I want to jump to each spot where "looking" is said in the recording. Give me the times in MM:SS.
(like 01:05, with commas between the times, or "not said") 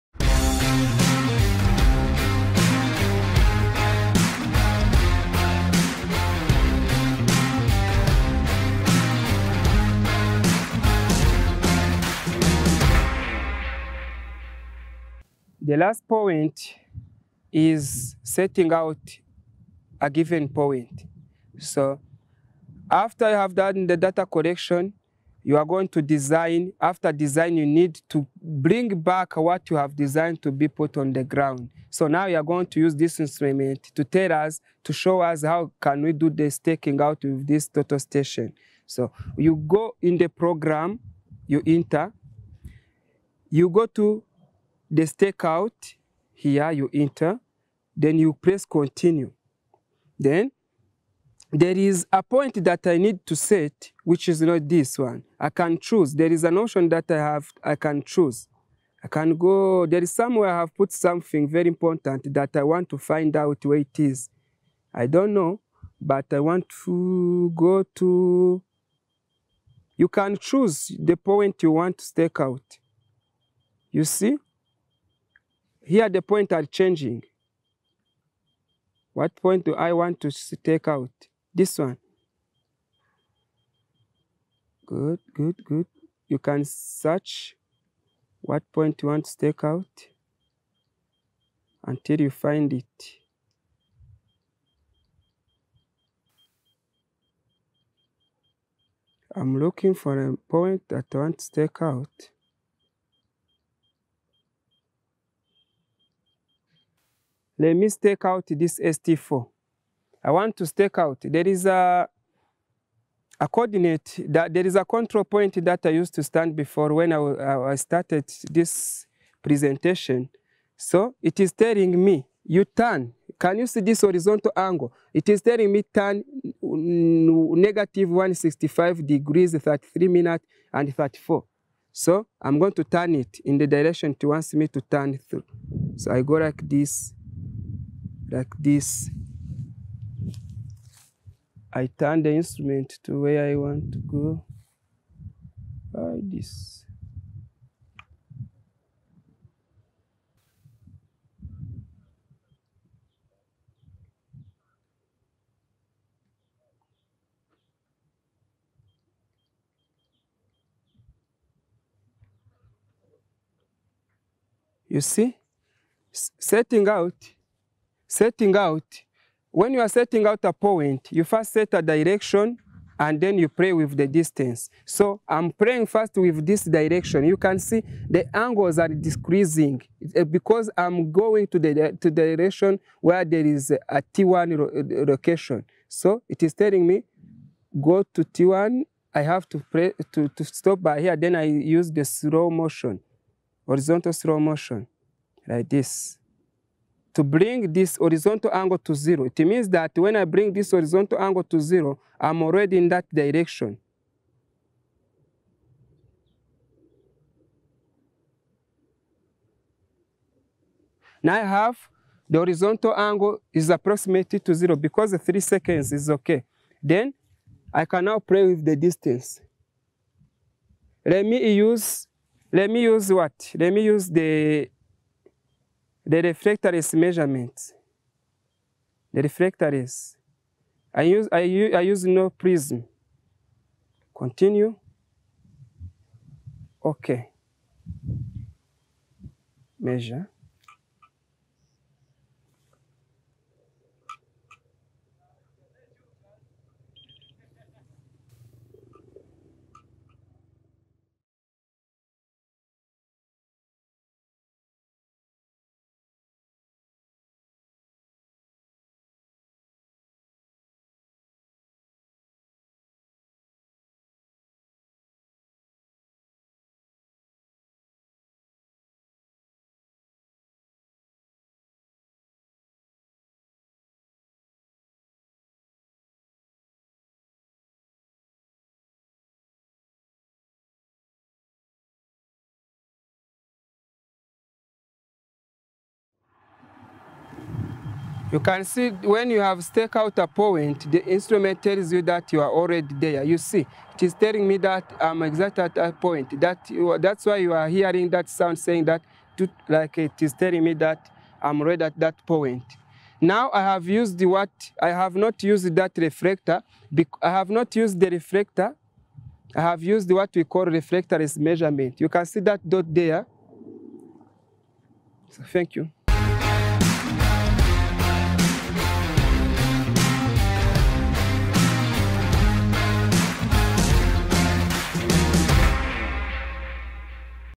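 01:39.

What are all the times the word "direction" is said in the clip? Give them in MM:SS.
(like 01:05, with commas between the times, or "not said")
02:13, 02:51, 02:56, 03:02, 03:23.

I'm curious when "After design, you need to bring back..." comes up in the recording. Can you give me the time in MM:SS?
00:26.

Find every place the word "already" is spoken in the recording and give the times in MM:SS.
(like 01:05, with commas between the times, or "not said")
03:22, 04:52.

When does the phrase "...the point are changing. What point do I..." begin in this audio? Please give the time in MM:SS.
01:16.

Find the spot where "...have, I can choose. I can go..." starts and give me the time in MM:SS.
00:57.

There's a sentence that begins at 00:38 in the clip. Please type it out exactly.
So you go in the program, you enter, you go to the stakeout here you enter, then you press continue.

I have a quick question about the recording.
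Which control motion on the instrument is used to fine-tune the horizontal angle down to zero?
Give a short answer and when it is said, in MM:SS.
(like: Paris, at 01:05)
horizontal slow motion, at 03:13.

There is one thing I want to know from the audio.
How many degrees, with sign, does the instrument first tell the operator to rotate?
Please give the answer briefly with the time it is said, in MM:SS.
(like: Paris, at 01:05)
-165 degrees, at 02:06.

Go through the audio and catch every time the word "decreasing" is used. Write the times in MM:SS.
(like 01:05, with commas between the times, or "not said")
02:58.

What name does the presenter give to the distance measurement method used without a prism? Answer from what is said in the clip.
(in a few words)
reflectorless measurement.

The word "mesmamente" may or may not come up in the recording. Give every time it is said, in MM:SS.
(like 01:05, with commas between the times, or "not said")
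03:46.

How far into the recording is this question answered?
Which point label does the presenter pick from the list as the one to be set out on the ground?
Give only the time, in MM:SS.
01:48.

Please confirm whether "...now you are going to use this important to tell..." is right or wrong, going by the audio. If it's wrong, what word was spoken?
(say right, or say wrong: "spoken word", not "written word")
wrong: "instrument", not "important".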